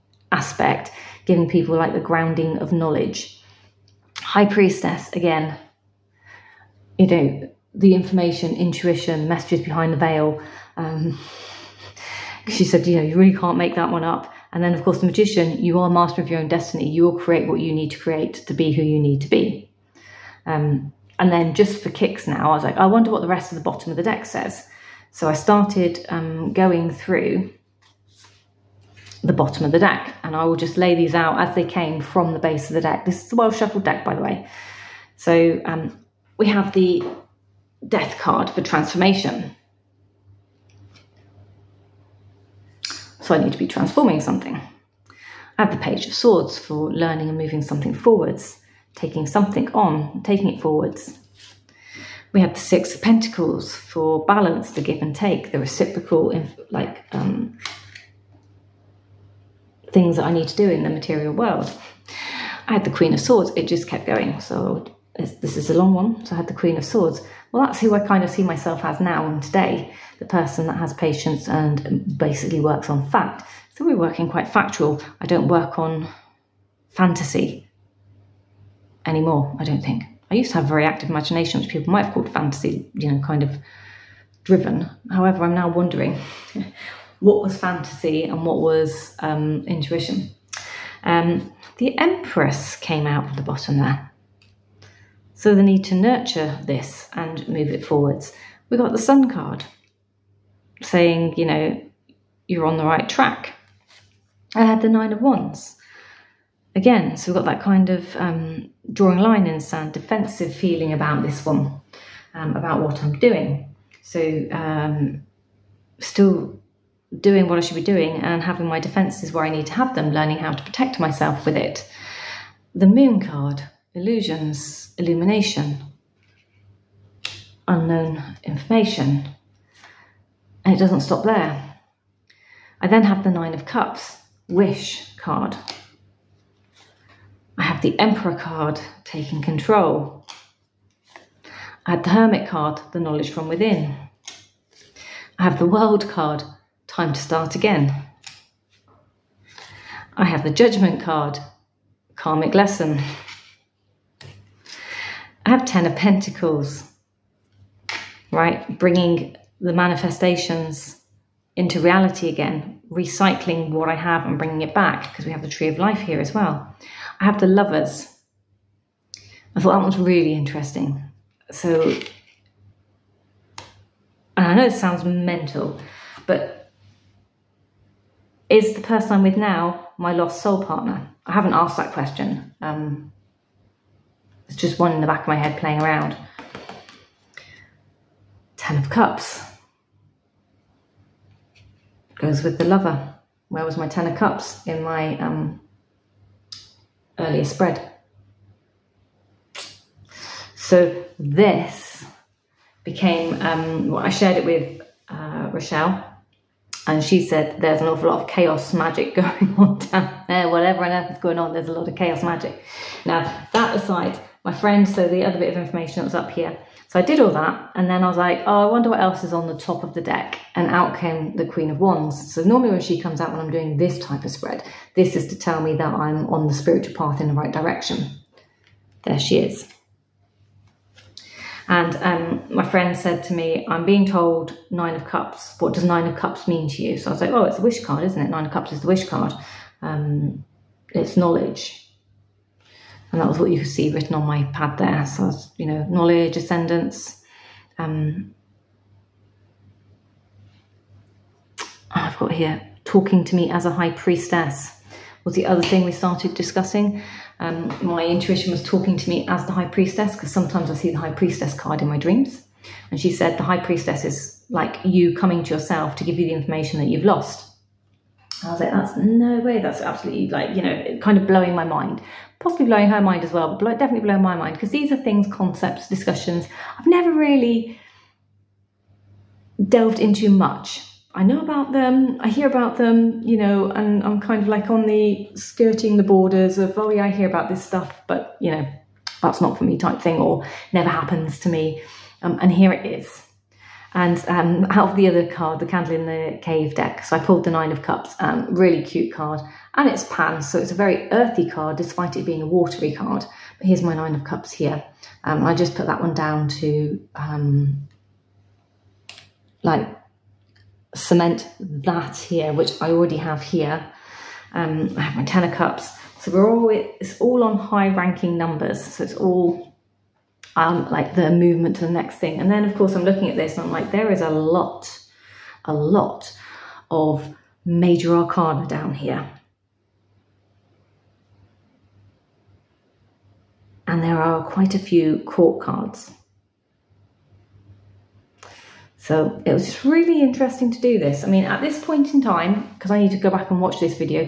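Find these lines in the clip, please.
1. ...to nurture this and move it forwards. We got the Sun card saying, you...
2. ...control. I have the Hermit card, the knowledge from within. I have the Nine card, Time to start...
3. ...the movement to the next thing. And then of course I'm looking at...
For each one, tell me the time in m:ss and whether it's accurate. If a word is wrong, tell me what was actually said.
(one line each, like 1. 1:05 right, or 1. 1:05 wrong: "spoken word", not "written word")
1. 1:35 right
2. 2:19 wrong: "World", not "Nine"
3. 5:21 right.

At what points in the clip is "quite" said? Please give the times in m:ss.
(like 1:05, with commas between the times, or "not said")
1:14, 5:34.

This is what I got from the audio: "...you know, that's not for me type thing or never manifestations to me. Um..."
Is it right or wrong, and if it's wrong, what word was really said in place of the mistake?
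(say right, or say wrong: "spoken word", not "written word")
wrong: "happens", not "manifestations".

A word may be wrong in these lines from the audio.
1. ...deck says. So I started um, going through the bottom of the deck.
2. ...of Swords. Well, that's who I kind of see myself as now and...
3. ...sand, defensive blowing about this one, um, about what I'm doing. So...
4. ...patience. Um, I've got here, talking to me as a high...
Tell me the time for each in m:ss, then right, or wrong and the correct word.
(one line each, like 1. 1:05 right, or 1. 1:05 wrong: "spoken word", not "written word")
1. 0:24 right
2. 1:06 right
3. 1:49 wrong: "feeling", not "blowing"
4. 4:06 wrong: "ascendance", not "patience".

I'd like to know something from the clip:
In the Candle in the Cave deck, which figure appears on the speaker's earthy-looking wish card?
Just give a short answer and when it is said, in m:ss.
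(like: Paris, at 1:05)
Pan, at 5:00.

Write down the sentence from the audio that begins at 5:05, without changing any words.
Um, I just put that one down to um, like cement that here, which I already have here.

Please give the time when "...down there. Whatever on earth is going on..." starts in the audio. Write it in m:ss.
3:29.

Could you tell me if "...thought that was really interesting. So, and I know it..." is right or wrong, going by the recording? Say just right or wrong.
right.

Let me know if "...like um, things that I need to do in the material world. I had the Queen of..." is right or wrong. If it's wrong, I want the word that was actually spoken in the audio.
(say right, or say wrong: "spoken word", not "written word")
right.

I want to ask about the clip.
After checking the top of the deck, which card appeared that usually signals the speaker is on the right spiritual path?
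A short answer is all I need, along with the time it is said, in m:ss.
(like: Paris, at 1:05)
Queen of Wands, at 3:41.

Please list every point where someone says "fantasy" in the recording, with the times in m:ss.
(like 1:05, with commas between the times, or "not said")
1:16, 1:22, 1:27.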